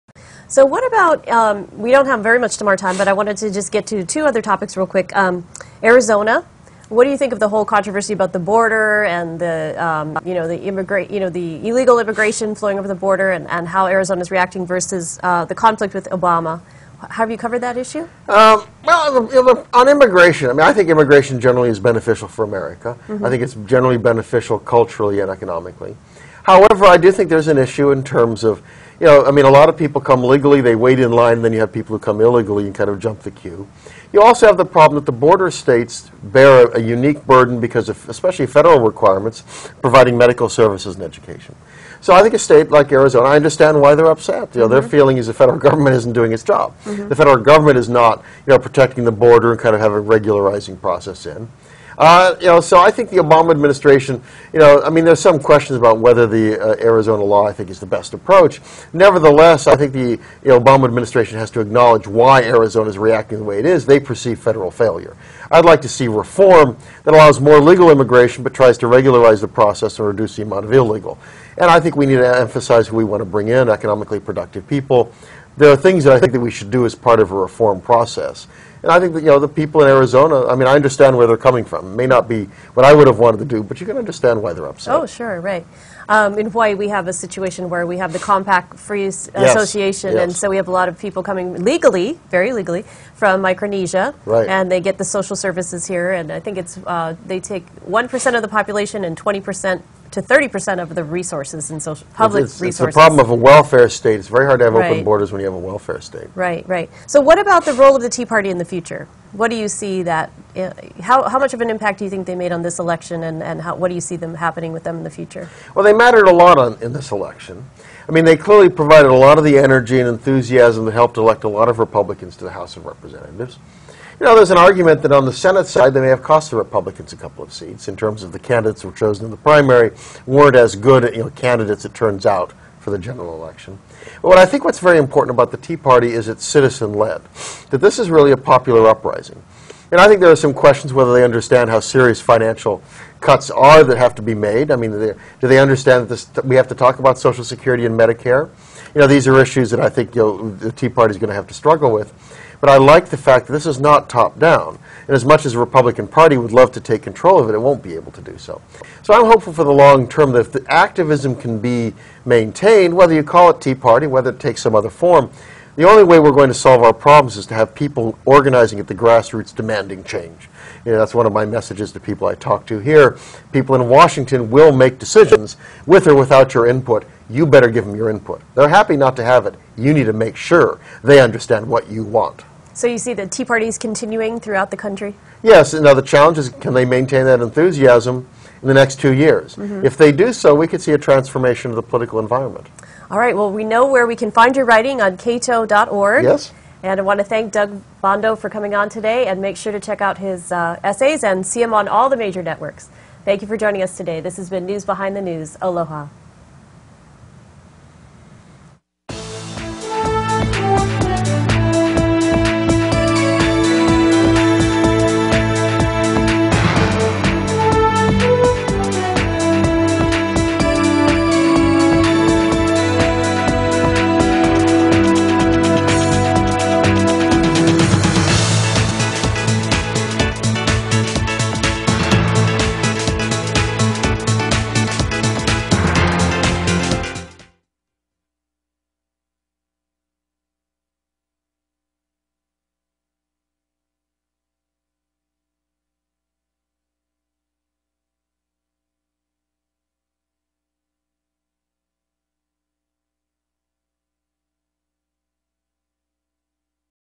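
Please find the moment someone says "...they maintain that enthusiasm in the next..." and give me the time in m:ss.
3:06.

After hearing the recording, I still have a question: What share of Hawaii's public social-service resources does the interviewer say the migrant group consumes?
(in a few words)
20% to 30%.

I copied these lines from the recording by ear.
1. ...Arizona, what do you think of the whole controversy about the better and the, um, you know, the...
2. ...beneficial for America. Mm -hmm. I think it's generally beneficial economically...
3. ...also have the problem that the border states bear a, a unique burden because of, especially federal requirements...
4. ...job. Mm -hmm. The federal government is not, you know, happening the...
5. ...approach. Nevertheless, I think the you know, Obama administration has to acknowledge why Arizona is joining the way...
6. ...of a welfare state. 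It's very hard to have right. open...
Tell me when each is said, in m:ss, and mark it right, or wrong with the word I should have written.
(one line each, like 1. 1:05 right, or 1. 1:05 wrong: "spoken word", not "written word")
1. 0:05 wrong: "border", not "better"
2. 0:21 wrong: "culturally", not "economically"
3. 0:34 right
4. 0:46 wrong: "protecting", not "happening"
5. 0:58 wrong: "reacting", not "joining"
6. 1:43 right.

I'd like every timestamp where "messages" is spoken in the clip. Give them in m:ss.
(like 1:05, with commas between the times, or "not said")
2:51.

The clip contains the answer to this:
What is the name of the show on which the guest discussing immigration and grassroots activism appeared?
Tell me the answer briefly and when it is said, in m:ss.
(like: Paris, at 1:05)
News Behind the News, at 3:24.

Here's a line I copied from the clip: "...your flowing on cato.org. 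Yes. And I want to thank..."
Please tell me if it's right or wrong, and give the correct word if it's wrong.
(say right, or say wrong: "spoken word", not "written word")
wrong: "writing", not "flowing".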